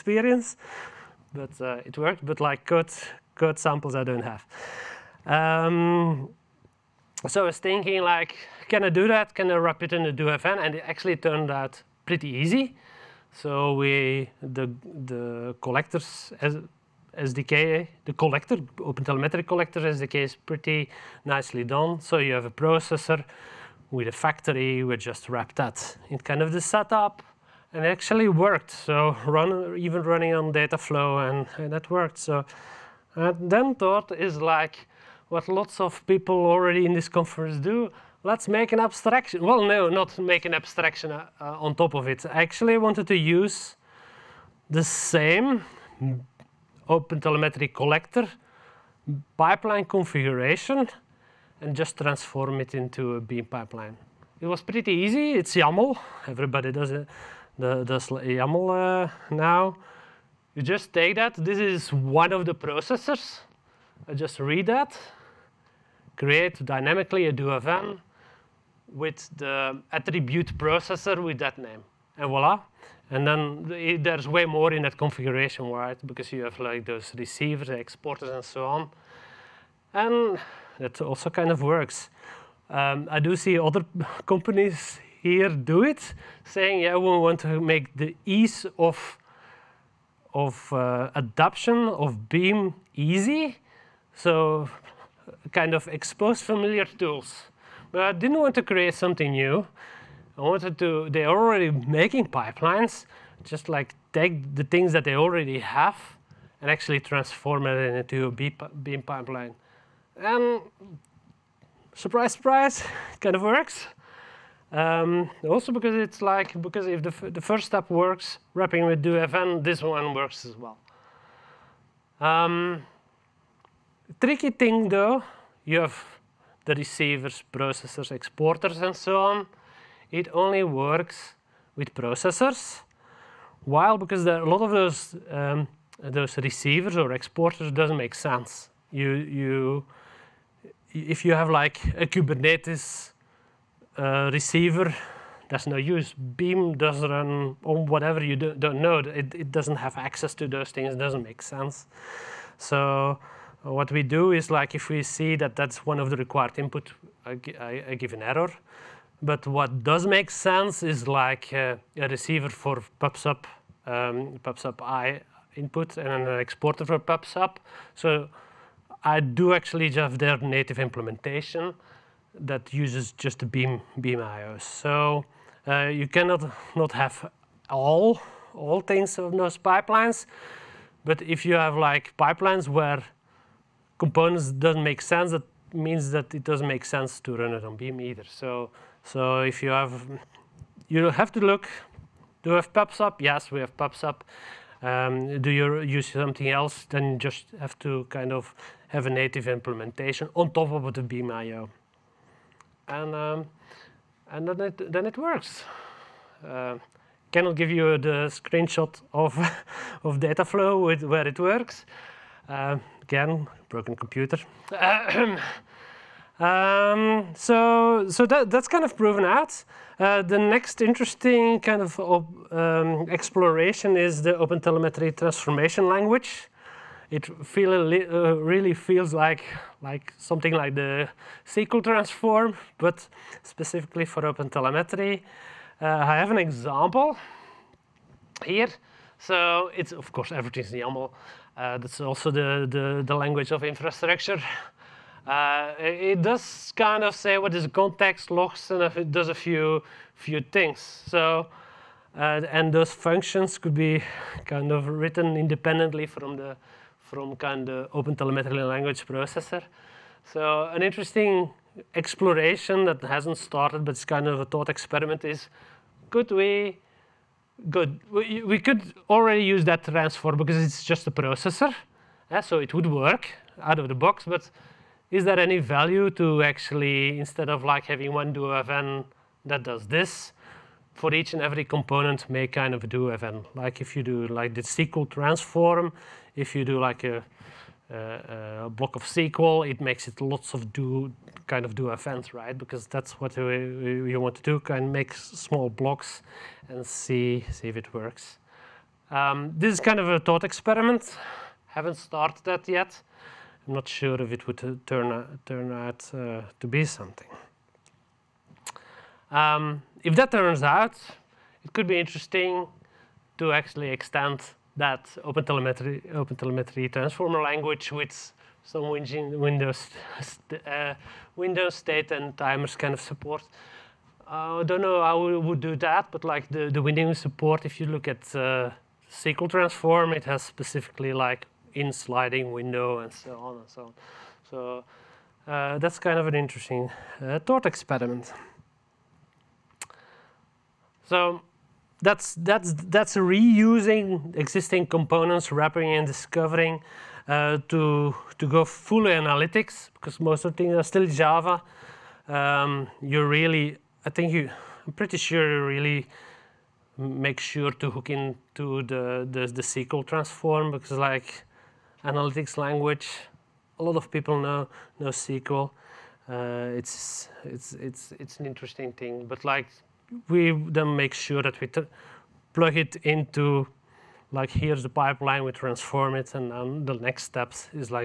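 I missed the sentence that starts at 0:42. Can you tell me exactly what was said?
I actually wanted to use the same OpenTelemetry collector pipeline configuration and just transform it into a Beam pipeline.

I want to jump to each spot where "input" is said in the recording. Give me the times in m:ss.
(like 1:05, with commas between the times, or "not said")
2:36, 2:45.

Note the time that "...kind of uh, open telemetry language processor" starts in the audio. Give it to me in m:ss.
4:17.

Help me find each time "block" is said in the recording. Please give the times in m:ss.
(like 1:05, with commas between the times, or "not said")
4:48, 4:55.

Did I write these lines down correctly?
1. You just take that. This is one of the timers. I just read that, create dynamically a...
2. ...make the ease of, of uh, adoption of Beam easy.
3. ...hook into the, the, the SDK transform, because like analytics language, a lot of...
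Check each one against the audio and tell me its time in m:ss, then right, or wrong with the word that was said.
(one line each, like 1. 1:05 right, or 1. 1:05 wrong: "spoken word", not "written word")
1. 1:00 wrong: "processors", not "timers"
2. 1:27 right
3. 5:57 wrong: "SQL", not "SDK".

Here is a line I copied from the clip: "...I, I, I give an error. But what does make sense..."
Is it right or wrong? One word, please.
right.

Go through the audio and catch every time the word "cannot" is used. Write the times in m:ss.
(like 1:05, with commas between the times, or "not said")
2:56, 3:27.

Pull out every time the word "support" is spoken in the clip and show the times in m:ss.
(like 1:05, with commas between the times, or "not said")
5:23, 5:27.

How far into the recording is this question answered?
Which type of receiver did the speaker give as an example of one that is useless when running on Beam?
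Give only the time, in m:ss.
2:22.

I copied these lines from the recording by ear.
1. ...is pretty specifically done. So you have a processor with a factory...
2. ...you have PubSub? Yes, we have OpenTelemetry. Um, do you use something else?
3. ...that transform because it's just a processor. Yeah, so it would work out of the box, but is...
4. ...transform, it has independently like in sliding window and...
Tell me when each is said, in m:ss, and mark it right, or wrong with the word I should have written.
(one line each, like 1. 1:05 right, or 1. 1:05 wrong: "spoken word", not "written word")
1. 0:20 wrong: "nicely", not "specifically"
2. 3:12 wrong: "PubSub", not "OpenTelemetry"
3. 4:29 right
4. 5:29 wrong: "specifically", not "independently".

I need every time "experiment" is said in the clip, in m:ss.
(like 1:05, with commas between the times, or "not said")
4:24, 5:00, 5:37.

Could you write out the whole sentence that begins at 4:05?
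Uh, it does kind of say what is context logs and it does a few few things.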